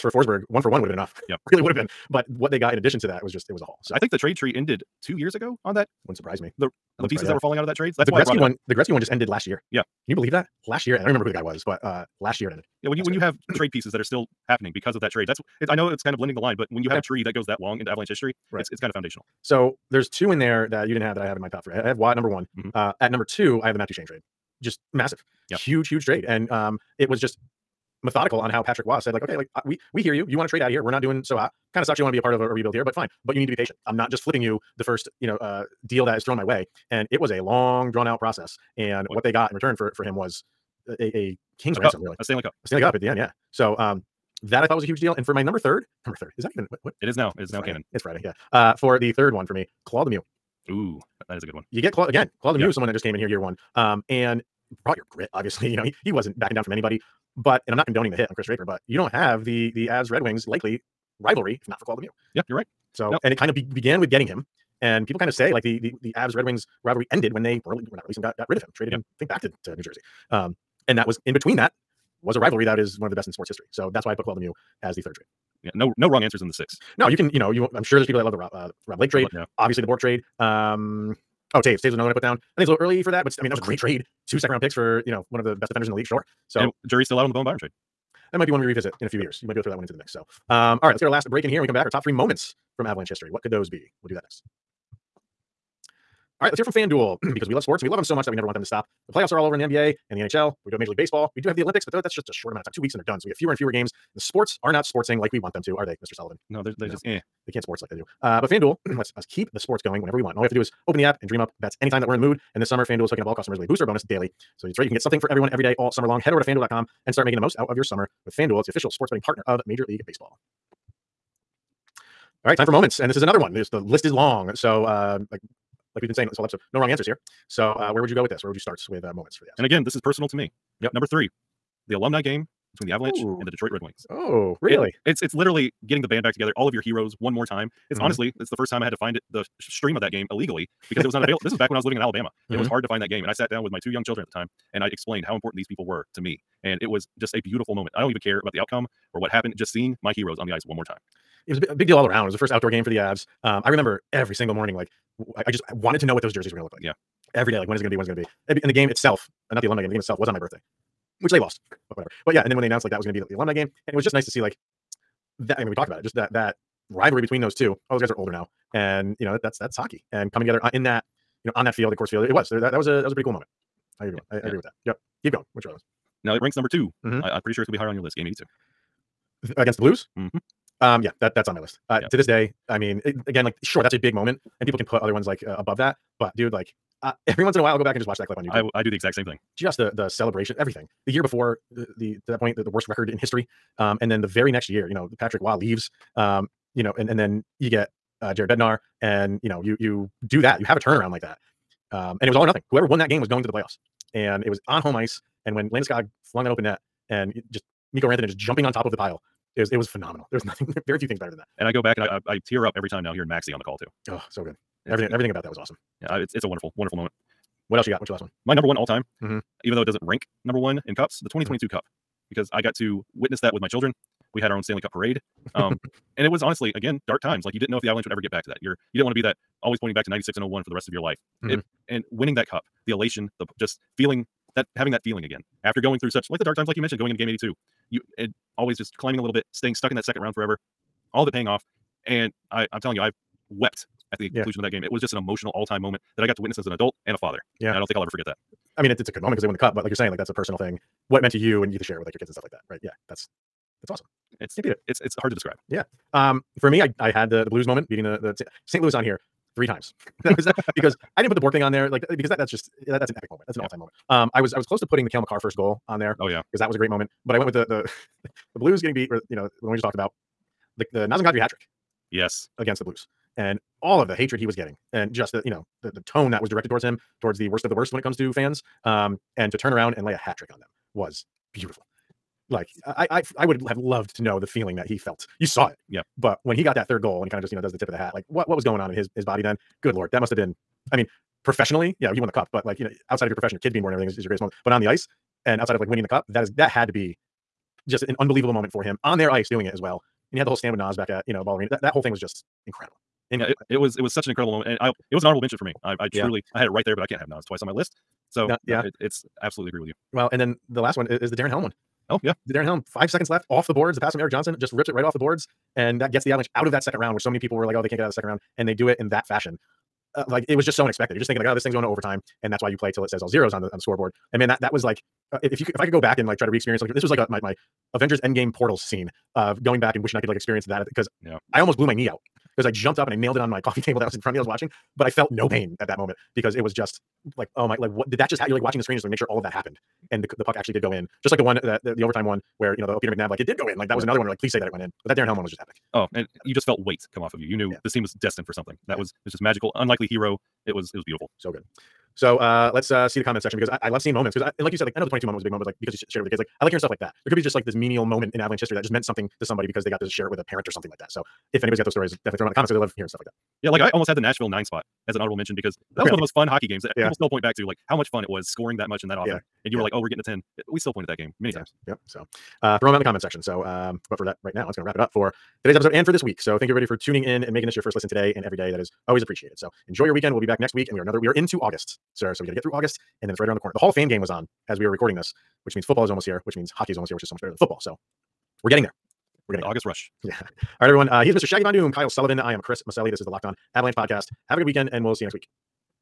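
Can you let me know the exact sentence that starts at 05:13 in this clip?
The pass from Erik Johnson just rips it right off the boards.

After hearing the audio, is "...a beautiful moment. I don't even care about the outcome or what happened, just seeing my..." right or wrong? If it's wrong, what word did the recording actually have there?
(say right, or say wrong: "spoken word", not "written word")
right.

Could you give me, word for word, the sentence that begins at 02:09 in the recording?
And again, this is personal to me.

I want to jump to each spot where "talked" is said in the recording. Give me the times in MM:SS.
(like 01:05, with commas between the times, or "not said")
02:45, 04:29.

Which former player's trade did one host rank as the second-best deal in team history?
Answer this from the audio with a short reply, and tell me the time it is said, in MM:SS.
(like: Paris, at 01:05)
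Matt Duchene, at 00:23.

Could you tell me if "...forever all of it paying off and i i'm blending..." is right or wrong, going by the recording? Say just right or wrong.
wrong.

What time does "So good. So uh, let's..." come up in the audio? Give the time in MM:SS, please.
05:51.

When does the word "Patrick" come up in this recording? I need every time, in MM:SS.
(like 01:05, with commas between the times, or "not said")
00:28, 03:15.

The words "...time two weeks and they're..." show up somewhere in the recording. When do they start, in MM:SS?
01:42.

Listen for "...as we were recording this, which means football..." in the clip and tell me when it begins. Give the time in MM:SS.
06:24.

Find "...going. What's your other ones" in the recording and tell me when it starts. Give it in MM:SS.
02:55.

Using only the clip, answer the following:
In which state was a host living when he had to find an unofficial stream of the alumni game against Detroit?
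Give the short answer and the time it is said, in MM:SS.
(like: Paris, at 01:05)
Alabama, at 02:22.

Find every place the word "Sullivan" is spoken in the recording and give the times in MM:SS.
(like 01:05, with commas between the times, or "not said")
01:46, 06:32.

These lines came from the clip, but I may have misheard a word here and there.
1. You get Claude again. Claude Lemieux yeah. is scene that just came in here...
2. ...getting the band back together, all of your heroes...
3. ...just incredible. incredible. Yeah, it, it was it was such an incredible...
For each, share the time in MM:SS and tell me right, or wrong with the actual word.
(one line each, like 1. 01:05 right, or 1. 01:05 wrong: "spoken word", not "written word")
1. 00:51 wrong: "someone", not "scene"
2. 02:15 right
3. 05:02 right.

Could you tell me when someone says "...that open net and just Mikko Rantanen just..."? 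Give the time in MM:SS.
03:26.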